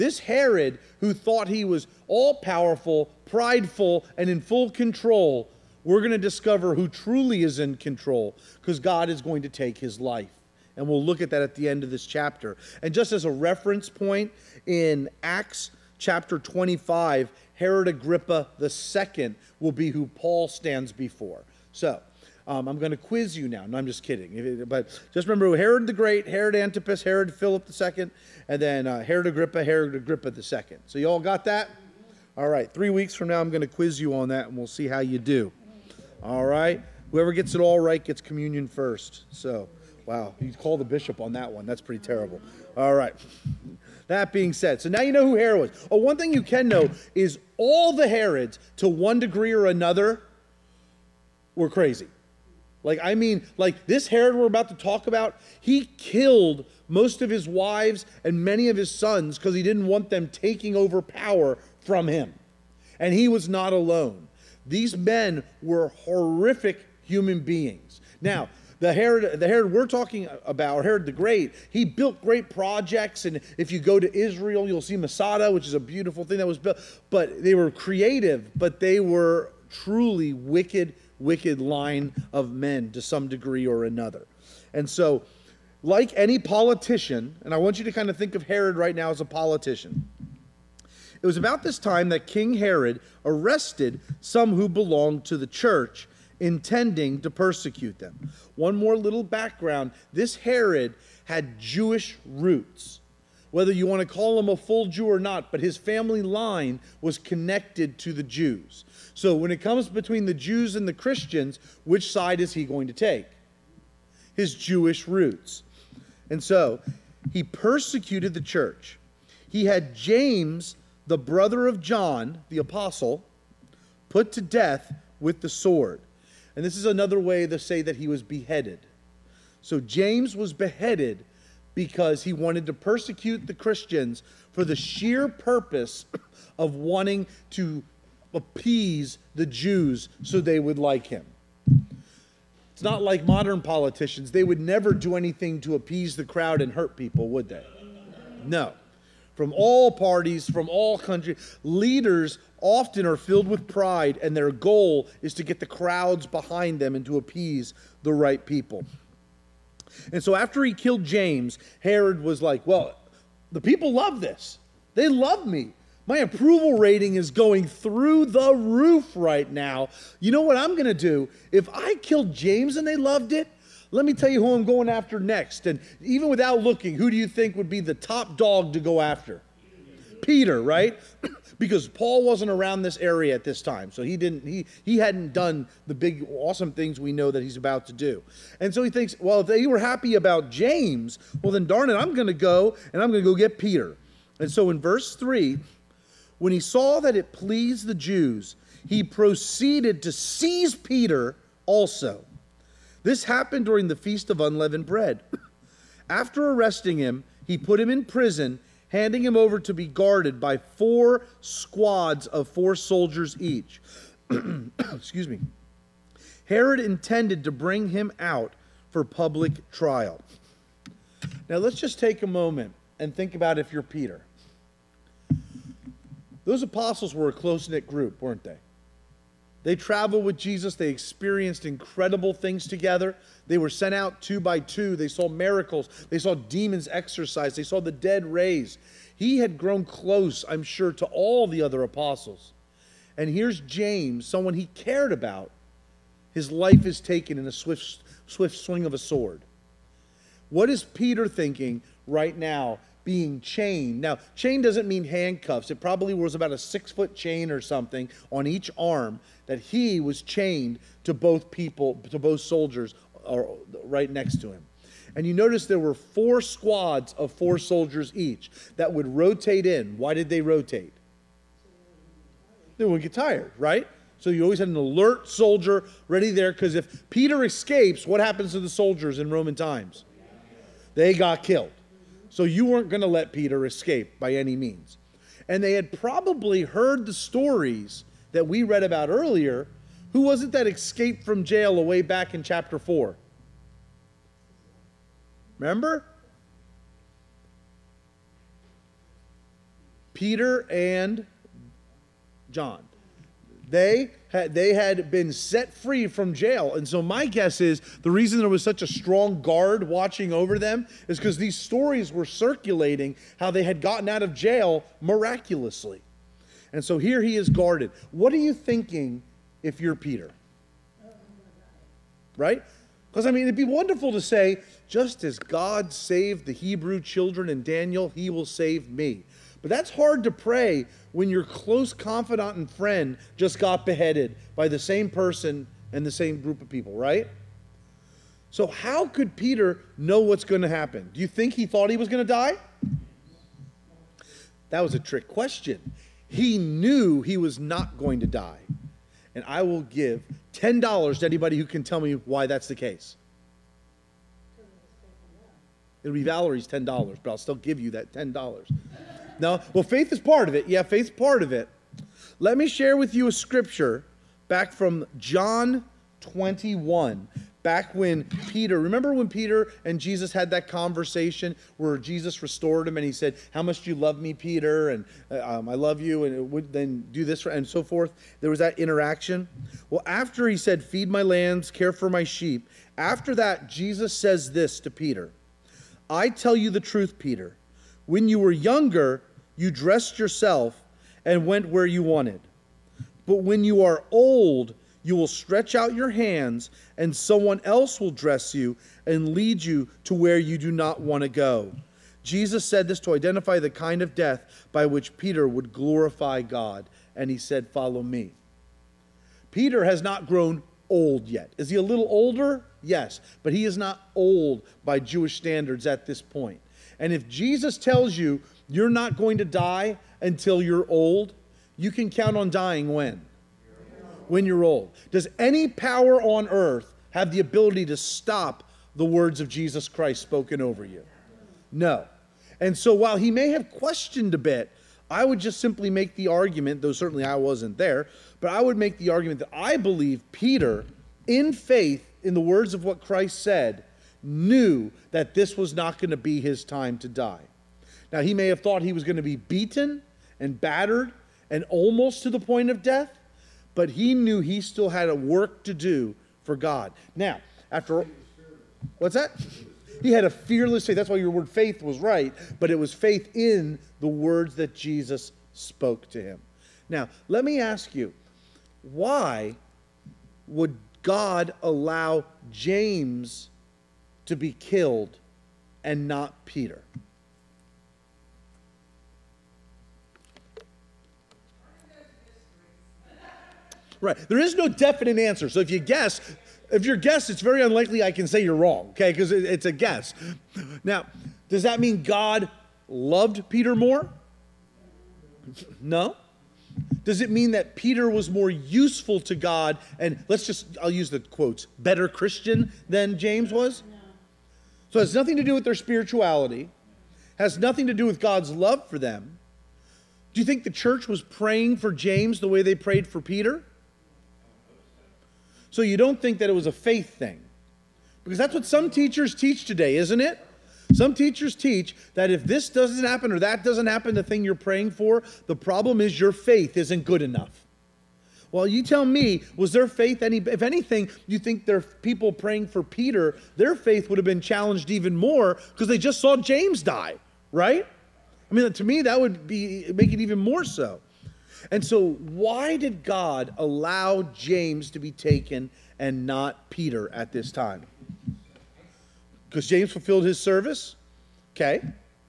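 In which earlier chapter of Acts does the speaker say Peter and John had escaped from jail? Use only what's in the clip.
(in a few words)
Chapter 4.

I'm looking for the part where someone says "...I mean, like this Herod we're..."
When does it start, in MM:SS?
00:53.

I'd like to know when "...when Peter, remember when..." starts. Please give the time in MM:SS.
06:07.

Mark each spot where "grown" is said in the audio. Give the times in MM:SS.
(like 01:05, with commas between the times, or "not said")
03:59, 06:50.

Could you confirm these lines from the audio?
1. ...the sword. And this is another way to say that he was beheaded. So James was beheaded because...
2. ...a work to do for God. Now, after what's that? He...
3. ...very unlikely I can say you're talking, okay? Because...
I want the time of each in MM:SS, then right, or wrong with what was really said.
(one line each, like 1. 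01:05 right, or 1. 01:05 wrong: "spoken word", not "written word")
1. 02:05 right
2. 07:35 right
3. 08:07 wrong: "wrong", not "talking".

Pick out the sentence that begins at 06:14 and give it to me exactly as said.
And uh, um, I love you, and would then do this and so forth.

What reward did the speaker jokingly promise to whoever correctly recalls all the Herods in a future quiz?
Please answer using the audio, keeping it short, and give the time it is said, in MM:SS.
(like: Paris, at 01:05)
Gets communion first, at 00:38.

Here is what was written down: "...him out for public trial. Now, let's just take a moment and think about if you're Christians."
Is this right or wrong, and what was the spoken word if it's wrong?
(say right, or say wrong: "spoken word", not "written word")
wrong: "Peter", not "Christians".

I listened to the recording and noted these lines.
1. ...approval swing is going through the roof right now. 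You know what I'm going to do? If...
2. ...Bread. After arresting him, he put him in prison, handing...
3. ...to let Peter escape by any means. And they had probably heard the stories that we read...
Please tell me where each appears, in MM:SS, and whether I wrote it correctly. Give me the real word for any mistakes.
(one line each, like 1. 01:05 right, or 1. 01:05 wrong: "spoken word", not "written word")
1. 02:46 wrong: "rating", not "swing"
2. 03:24 right
3. 04:43 right.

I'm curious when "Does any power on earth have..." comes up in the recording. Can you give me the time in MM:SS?
07:05.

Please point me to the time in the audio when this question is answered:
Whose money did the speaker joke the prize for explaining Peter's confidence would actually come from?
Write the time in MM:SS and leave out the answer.
05:56.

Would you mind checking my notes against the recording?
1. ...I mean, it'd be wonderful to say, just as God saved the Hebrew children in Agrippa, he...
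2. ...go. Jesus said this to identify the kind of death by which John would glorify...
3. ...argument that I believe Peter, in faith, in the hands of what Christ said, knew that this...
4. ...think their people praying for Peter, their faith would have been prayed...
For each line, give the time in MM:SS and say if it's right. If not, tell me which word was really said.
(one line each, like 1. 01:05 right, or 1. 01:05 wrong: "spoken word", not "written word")
1. 05:23 wrong: "Daniel", not "Agrippa"
2. 06:41 wrong: "Peter", not "John"
3. 07:19 wrong: "words", not "hands"
4. 08:51 wrong: "challenged", not "prayed".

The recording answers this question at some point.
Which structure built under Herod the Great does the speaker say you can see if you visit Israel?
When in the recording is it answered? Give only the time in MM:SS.
01:14.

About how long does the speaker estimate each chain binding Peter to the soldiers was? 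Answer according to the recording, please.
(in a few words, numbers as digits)
Six foot.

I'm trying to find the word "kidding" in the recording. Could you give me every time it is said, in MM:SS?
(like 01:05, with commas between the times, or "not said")
00:24.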